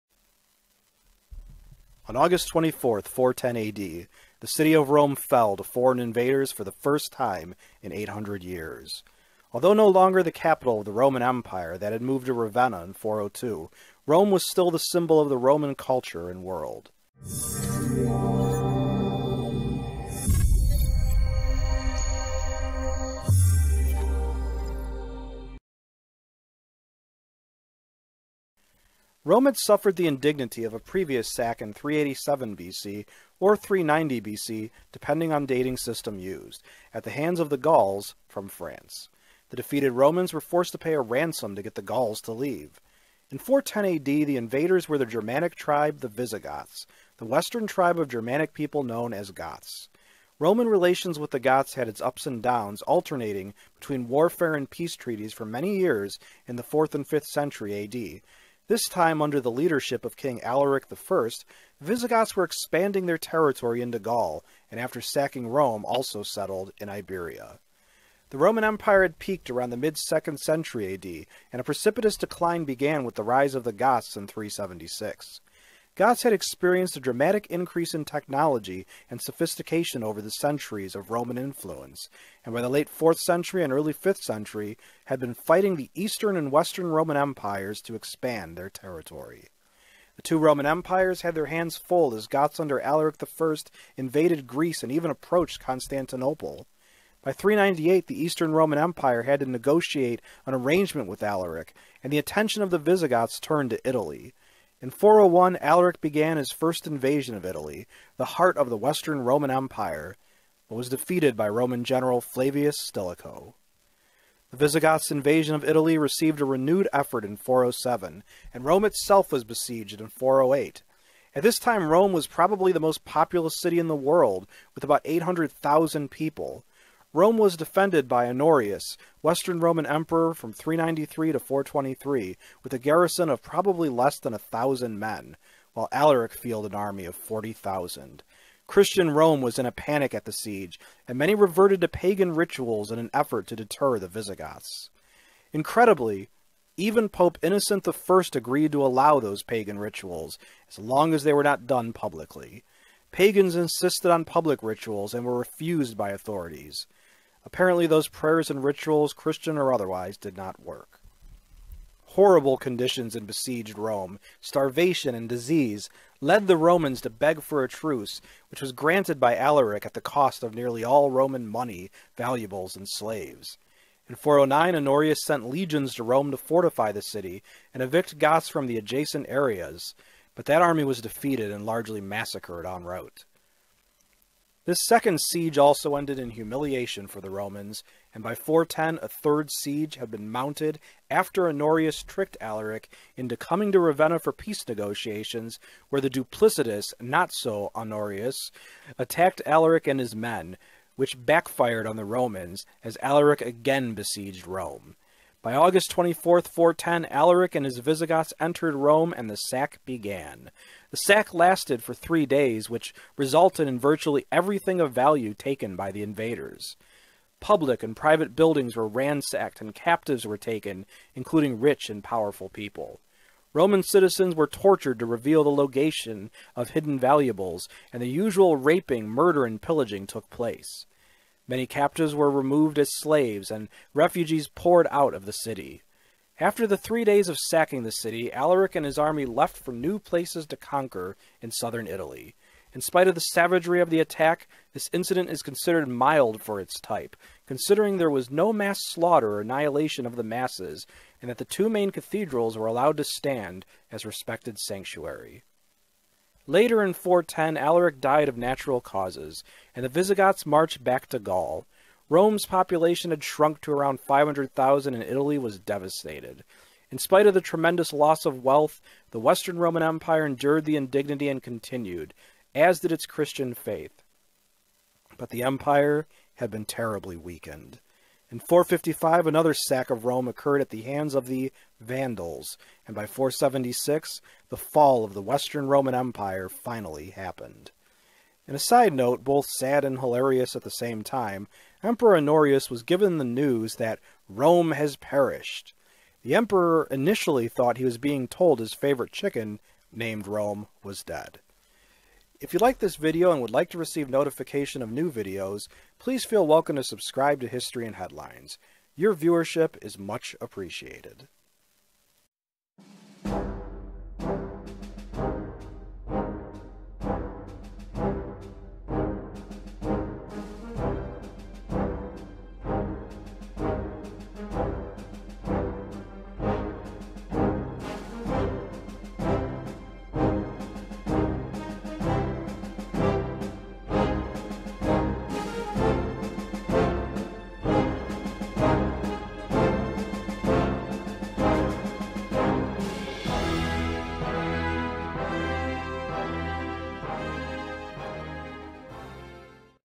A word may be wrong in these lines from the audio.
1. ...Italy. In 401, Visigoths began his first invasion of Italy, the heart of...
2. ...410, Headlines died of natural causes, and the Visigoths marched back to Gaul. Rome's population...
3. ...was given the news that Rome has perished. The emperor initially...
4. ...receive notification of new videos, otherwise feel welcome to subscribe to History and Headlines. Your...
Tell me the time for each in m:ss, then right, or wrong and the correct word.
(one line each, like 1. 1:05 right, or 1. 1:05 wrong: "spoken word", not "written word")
1. 1:43 wrong: "Alaric", not "Visigoths"
2. 4:16 wrong: "Alaric", not "Headlines"
3. 4:52 right
4. 5:03 wrong: "please", not "otherwise".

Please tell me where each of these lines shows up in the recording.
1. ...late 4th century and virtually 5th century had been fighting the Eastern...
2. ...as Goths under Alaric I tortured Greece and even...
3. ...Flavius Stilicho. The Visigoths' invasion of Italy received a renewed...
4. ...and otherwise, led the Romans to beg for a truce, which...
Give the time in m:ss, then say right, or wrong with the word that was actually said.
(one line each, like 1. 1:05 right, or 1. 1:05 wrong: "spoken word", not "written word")
1. 1:22 wrong: "early", not "virtually"
2. 1:32 wrong: "invaded", not "tortured"
3. 1:52 right
4. 2:45 wrong: "disease", not "otherwise".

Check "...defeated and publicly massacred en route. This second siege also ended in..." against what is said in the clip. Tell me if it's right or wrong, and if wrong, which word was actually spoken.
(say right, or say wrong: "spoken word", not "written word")
wrong: "largely", not "publicly".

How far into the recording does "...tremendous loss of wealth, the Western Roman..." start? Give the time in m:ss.
4:27.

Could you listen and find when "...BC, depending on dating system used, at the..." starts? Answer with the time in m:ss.
0:34.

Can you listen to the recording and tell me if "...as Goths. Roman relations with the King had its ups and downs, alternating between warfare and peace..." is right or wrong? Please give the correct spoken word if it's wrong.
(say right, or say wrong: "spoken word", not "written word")
wrong: "Goths", not "King".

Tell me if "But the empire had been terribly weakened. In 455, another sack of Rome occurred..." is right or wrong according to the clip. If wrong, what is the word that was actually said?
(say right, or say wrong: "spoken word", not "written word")
right.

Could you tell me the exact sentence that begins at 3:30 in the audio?
The sack lasted for three days, which resulted in virtually everything of value taken by the invaders.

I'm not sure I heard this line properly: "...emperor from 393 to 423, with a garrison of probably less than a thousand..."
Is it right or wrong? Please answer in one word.
right.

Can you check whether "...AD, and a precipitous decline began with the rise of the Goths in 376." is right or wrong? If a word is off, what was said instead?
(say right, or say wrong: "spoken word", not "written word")
right.